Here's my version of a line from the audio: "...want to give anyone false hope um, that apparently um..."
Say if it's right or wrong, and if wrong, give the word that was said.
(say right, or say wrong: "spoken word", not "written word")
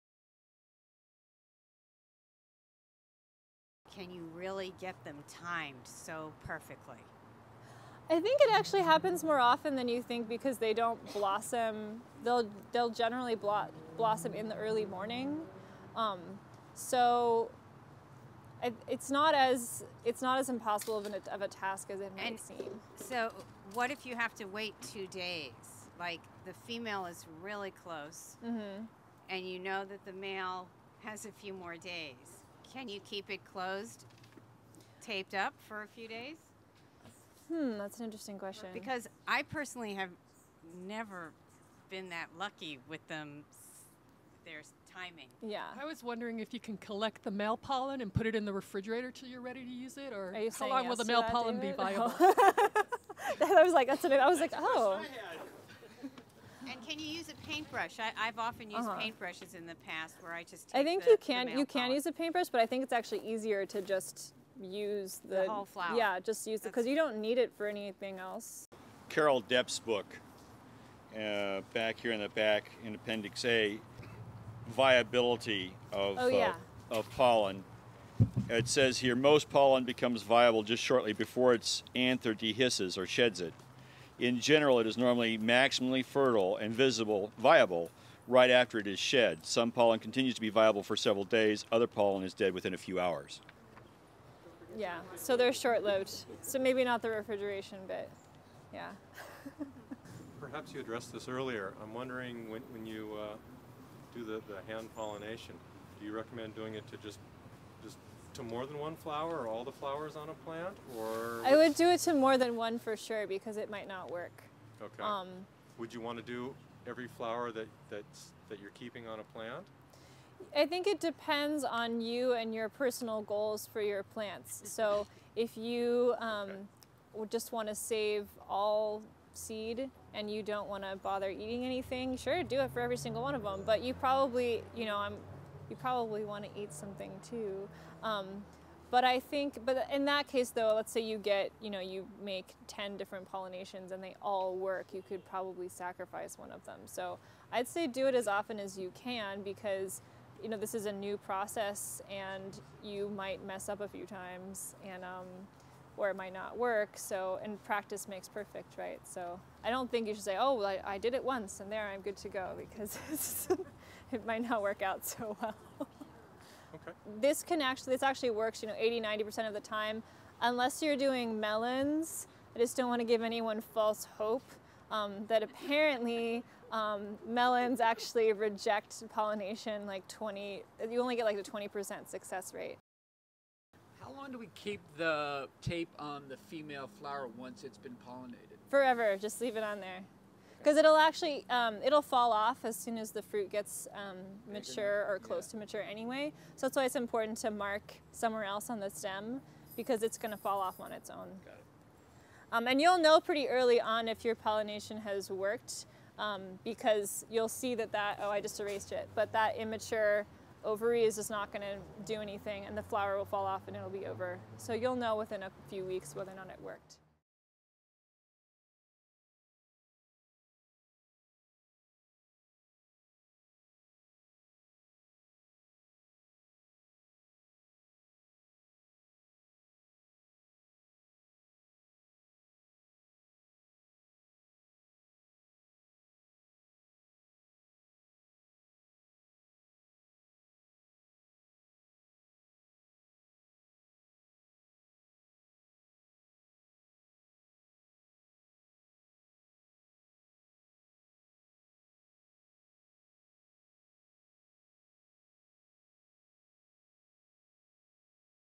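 right.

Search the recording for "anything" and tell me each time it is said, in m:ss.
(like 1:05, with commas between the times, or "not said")
1:07, 2:11, 3:32.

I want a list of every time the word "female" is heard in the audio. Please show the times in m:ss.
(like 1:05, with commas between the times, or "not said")
0:26, 3:06.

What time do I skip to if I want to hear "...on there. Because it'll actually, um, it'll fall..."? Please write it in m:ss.
3:09.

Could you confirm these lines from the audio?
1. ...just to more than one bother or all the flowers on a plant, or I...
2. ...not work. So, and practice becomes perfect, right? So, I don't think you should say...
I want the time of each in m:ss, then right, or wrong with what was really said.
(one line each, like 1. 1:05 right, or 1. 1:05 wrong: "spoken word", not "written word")
1. 1:47 wrong: "flower", not "bother"
2. 2:36 wrong: "makes", not "becomes".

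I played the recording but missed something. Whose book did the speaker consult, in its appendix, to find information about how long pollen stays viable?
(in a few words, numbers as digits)
Carol Deppe.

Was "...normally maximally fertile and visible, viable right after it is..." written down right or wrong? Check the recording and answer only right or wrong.
right.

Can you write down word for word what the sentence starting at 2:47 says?
This can actually, this actually works, you know, 80, 90% of the time.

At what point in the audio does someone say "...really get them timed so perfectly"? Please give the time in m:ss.
0:04.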